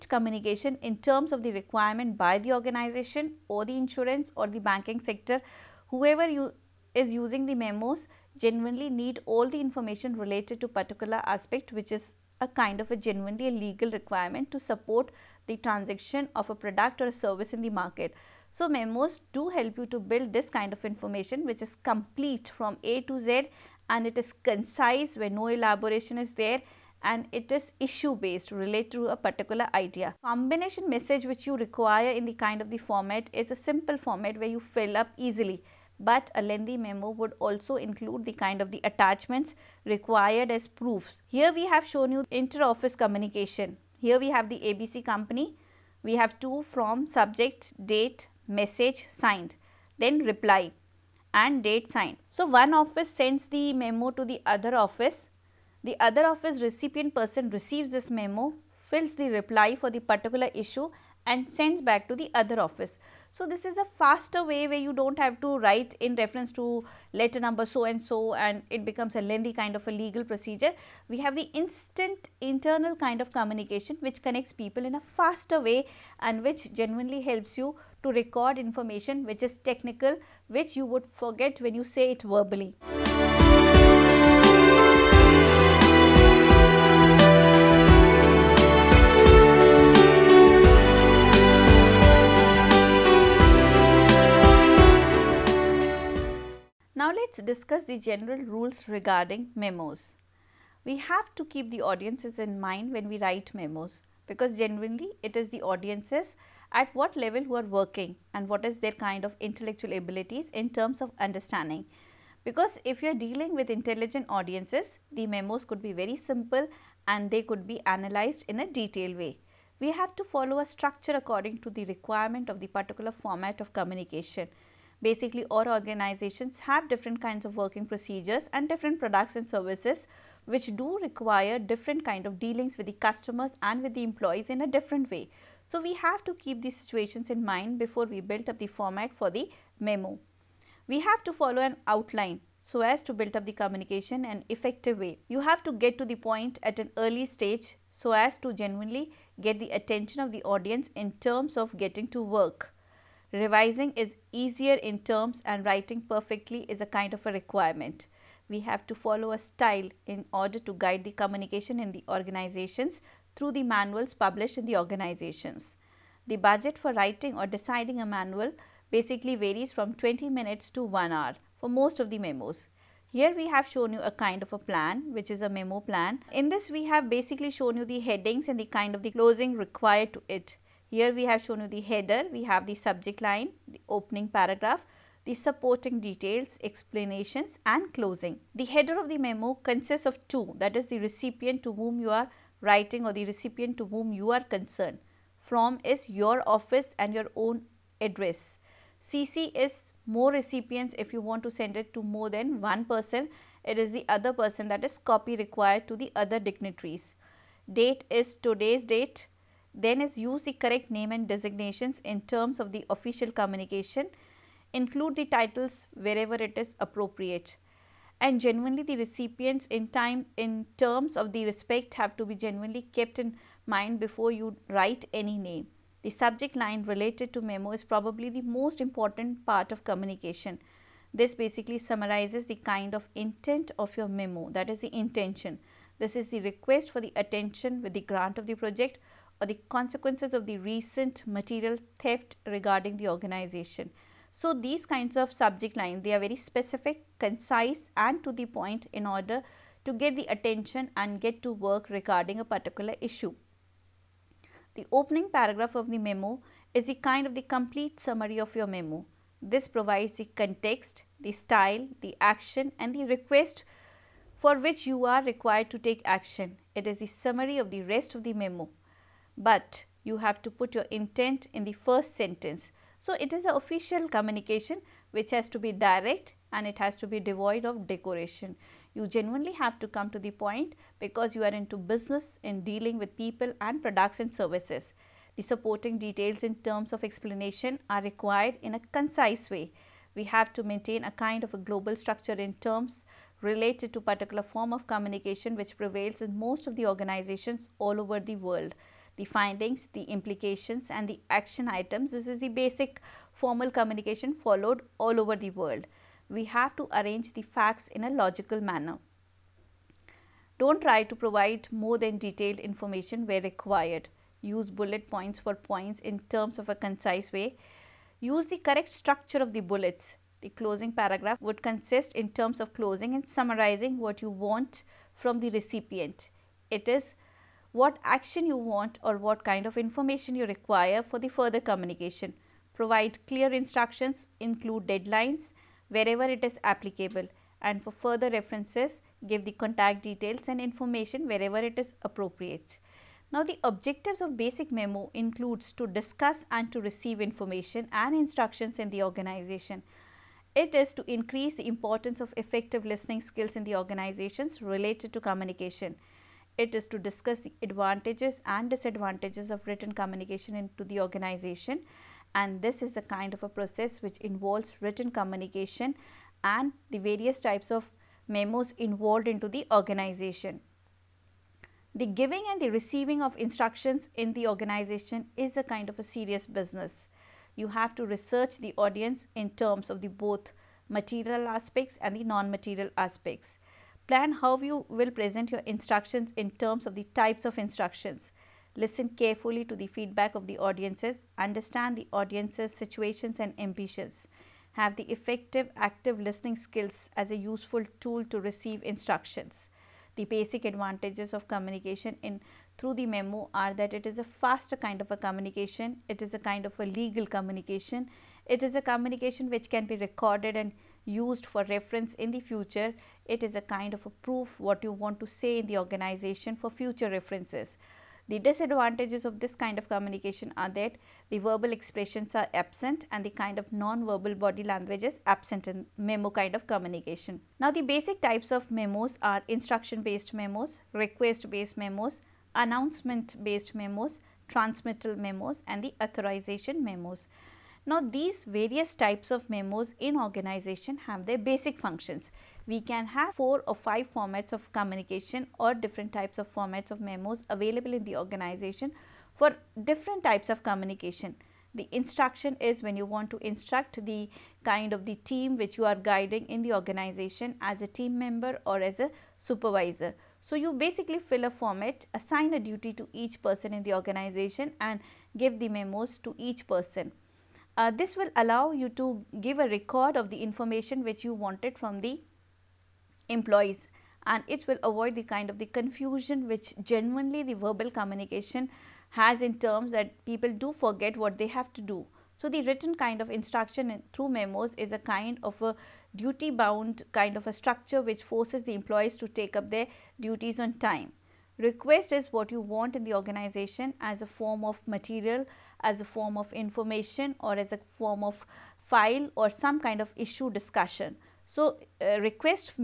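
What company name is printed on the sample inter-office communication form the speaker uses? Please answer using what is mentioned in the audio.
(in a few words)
ABC company.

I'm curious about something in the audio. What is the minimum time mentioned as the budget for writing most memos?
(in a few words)
20 minutes.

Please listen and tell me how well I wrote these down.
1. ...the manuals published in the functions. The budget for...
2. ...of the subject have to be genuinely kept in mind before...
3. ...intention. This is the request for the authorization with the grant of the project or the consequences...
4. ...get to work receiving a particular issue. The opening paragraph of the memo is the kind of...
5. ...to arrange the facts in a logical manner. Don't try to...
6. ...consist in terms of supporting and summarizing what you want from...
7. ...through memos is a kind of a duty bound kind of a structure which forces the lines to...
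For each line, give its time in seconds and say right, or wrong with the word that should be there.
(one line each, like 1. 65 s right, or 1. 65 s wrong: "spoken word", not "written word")
1. 163 s wrong: "organizations", not "functions"
2. 221 s wrong: "respect", not "subject"
3. 234 s wrong: "attention", not "authorization"
4. 251 s wrong: "regarding", not "receiving"
5. 306 s right
6. 321 s wrong: "closing", not "supporting"
7. 484 s wrong: "employees", not "lines".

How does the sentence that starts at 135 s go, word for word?
So, we have to keep these situations in mind before we build up the format for the memo.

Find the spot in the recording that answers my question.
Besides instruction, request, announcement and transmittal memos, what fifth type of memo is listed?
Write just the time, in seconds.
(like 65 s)
436 s.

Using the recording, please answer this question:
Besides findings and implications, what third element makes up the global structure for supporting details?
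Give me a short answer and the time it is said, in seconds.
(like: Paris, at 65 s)
Action items, at 301 s.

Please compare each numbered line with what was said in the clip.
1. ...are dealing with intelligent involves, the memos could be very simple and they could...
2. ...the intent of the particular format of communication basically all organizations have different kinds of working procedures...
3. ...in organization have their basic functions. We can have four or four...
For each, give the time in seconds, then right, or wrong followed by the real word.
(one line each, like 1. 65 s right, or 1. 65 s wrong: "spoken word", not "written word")
1. 113 s wrong: "audiences", not "involves"
2. 121 s wrong: "requirement", not "intent"
3. 439 s wrong: "five", not "four".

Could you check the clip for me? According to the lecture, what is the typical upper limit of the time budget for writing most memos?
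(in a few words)
1 hour.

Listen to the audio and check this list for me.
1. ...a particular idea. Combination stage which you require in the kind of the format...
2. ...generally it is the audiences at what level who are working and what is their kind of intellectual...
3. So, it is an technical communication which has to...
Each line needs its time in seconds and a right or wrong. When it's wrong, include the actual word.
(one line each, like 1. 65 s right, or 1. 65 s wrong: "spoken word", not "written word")
1. 29 s wrong: "message", not "stage"
2. 104 s right
3. 272 s wrong: "official", not "technical".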